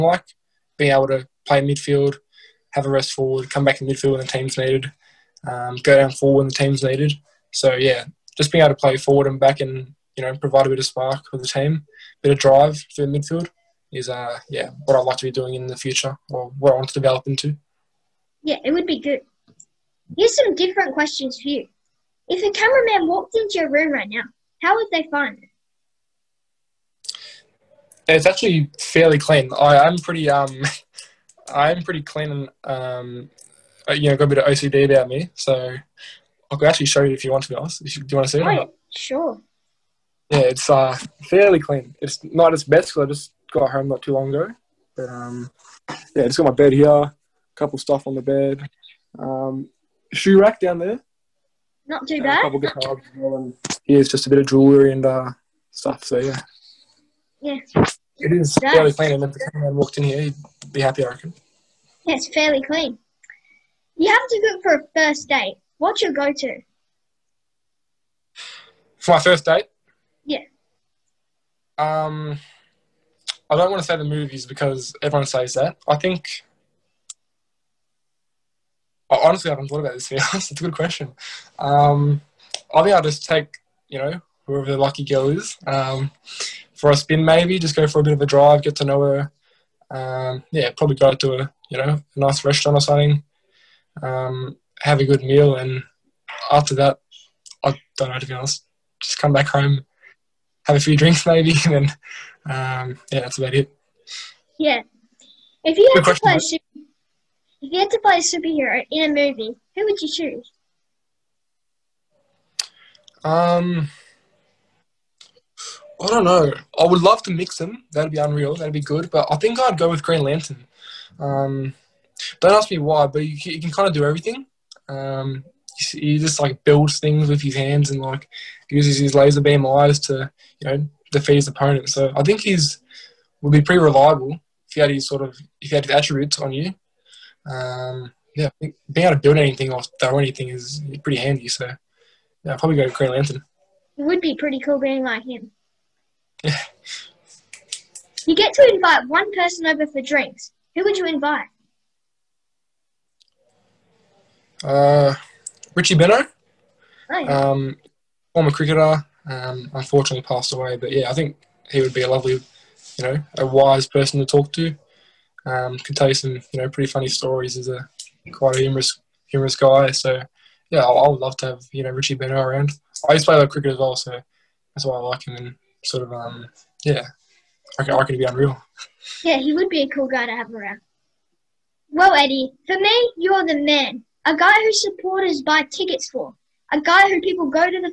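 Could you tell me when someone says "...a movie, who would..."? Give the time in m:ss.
1:49.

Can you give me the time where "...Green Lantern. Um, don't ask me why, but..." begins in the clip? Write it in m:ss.
2:00.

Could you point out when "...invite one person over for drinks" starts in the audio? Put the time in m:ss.
2:28.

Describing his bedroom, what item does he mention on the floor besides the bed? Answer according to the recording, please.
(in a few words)
shoe rack.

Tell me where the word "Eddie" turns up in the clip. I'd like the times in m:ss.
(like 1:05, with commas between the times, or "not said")
3:02.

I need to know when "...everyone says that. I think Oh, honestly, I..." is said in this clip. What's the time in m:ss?
1:15.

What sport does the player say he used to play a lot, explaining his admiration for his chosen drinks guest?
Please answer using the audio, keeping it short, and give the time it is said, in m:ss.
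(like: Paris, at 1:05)
cricket, at 2:53.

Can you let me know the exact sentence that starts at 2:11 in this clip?
So I think he's would be pretty reliable if he had his sort of if he had his attributes on you.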